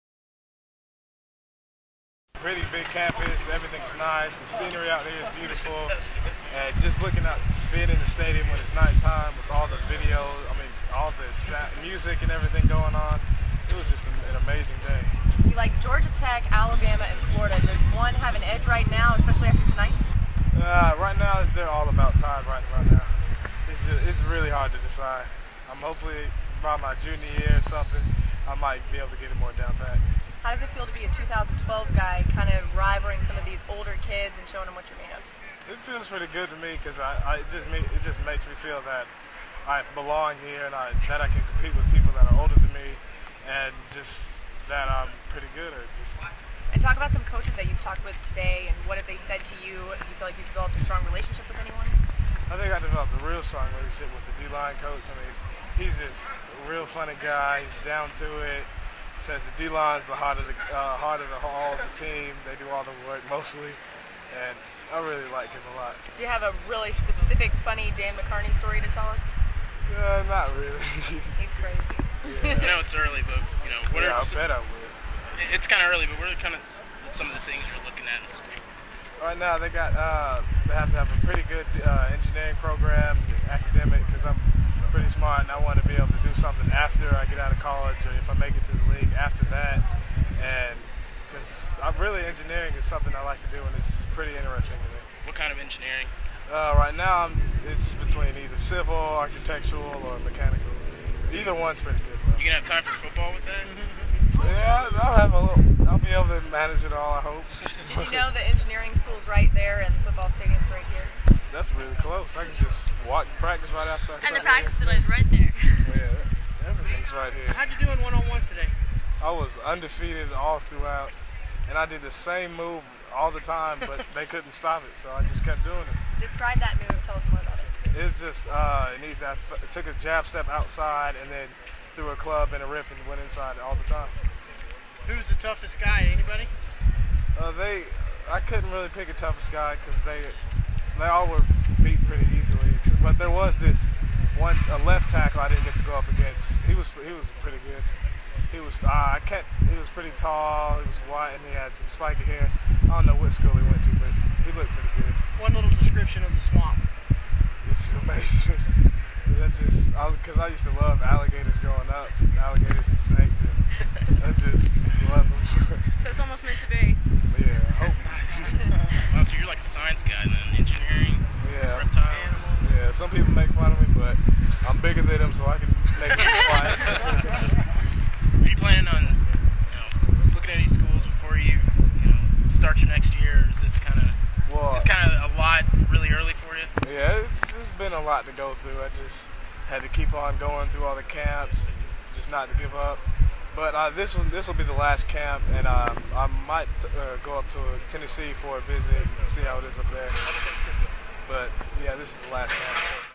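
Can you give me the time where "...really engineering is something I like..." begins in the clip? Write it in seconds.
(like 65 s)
92 s.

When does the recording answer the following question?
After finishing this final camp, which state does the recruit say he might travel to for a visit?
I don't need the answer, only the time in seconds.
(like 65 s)
197 s.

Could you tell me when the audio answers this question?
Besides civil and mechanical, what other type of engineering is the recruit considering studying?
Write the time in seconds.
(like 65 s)
98 s.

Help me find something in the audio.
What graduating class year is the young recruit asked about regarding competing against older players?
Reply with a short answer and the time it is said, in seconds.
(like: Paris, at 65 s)
2012, at 31 s.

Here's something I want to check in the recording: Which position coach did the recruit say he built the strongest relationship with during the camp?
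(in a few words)
D-line coach.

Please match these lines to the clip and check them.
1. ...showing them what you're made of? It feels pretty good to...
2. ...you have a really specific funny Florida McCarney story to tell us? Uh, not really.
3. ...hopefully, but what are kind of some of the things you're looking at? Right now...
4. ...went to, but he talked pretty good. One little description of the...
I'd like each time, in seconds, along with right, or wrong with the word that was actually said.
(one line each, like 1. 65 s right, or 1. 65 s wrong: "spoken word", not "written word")
1. 34 s right
2. 66 s wrong: "Dan", not "Florida"
3. 75 s wrong: "early", not "hopefully"
4. 153 s wrong: "looked", not "talked".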